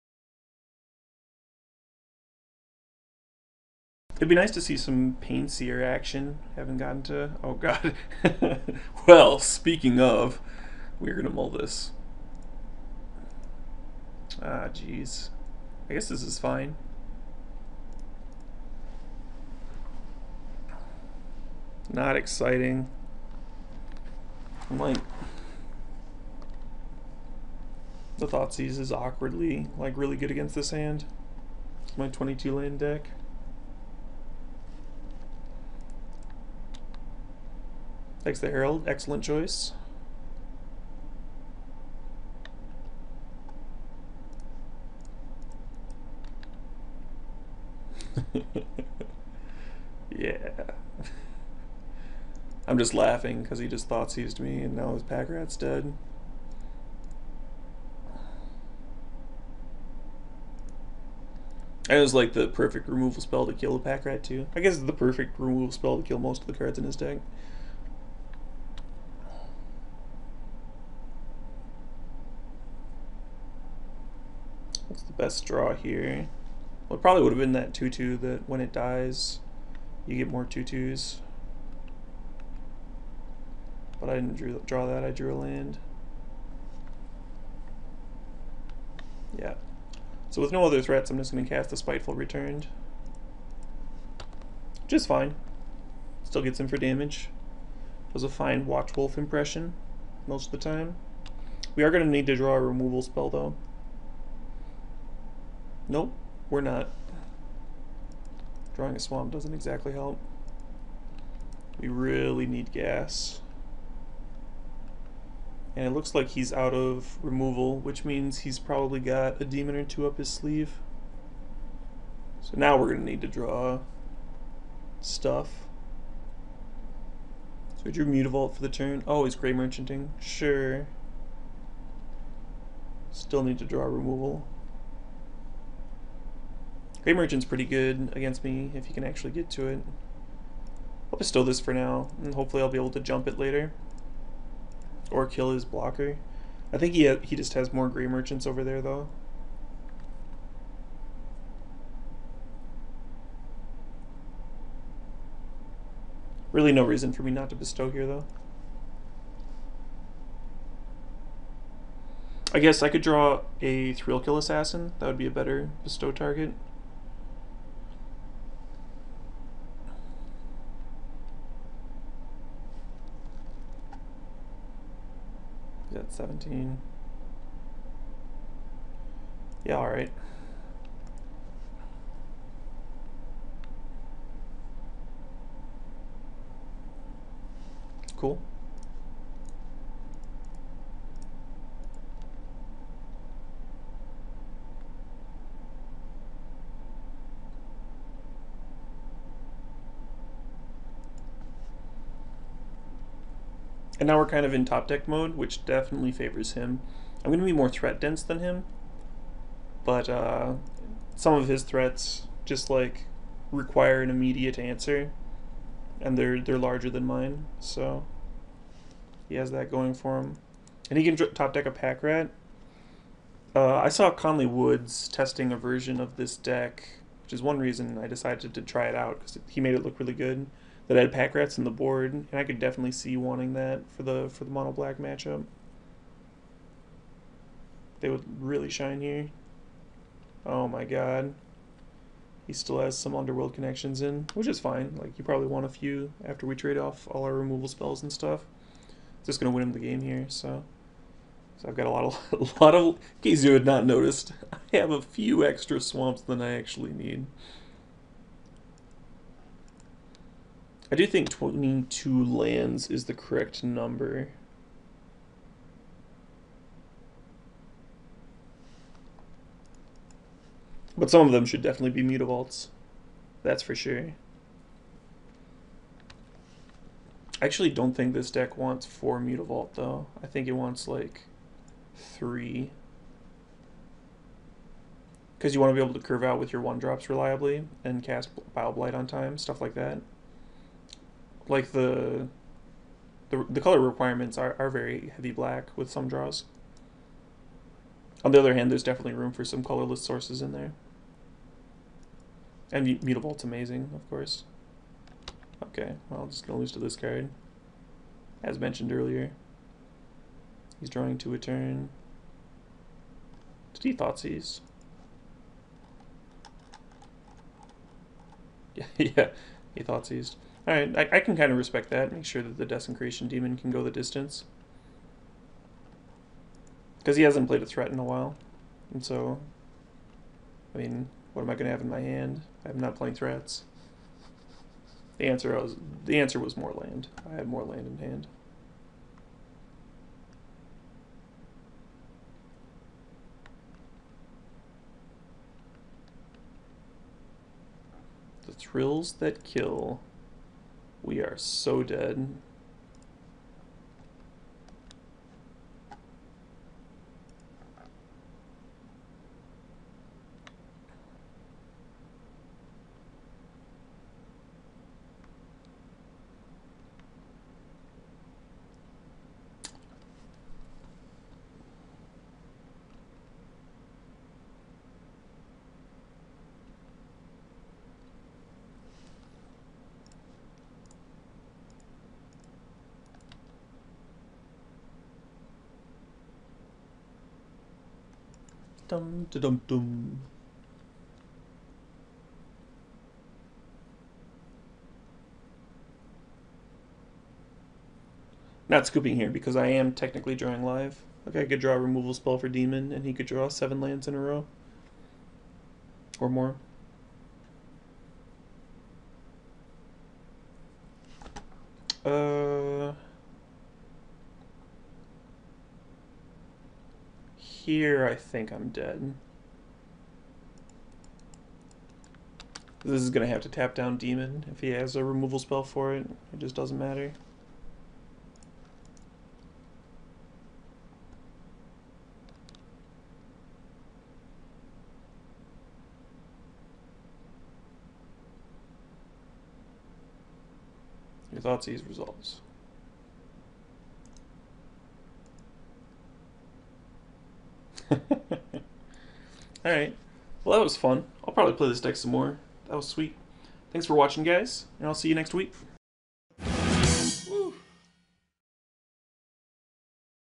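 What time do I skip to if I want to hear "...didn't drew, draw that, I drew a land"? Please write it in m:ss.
1:24.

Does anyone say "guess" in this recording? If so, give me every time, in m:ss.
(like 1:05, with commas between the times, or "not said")
0:15, 1:04, 2:42.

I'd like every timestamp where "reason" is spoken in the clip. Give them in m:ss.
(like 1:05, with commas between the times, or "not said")
2:36, 3:47.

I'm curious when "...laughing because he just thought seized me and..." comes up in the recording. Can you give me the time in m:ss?
0:52.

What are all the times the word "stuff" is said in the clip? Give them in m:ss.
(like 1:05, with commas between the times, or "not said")
2:05, 4:08, 4:49.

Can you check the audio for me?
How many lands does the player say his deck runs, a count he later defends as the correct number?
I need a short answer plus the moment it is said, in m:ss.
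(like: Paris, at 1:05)
22, at 0:32.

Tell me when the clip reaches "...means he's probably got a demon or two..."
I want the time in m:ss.
1:58.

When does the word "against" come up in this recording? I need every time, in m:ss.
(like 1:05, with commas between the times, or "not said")
0:30, 2:18.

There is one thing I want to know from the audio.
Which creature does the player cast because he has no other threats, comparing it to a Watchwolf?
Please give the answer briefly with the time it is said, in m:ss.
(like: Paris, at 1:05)
Spiteful Returned, at 1:31.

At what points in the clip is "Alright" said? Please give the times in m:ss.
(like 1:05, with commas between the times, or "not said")
5:20, 7:29.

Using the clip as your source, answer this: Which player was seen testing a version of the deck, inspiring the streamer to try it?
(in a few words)
Conley Woods.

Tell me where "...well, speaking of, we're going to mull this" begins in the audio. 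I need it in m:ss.
0:09.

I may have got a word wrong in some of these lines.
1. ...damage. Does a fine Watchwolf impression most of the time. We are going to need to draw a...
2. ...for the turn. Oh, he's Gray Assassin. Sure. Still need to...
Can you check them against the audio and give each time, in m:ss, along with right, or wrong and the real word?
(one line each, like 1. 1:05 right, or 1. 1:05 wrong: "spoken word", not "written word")
1. 1:36 right
2. 2:08 wrong: "Merchanting", not "Assassin".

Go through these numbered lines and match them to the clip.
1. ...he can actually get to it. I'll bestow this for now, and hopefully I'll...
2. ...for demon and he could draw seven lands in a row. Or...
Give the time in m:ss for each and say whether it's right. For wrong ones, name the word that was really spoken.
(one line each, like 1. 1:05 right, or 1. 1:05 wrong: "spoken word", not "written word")
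1. 2:18 right
2. 6:42 right.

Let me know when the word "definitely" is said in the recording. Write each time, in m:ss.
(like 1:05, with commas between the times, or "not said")
3:25, 3:52, 4:31, 4:58.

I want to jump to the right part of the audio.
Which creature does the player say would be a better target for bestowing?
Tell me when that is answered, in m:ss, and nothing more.
2:43.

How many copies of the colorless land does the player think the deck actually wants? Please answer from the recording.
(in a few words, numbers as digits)
3.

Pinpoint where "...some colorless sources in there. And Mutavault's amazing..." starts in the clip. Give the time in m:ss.
4:59.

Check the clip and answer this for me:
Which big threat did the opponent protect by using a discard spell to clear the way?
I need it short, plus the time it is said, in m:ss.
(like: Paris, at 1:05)
Desecration Demon, at 5:22.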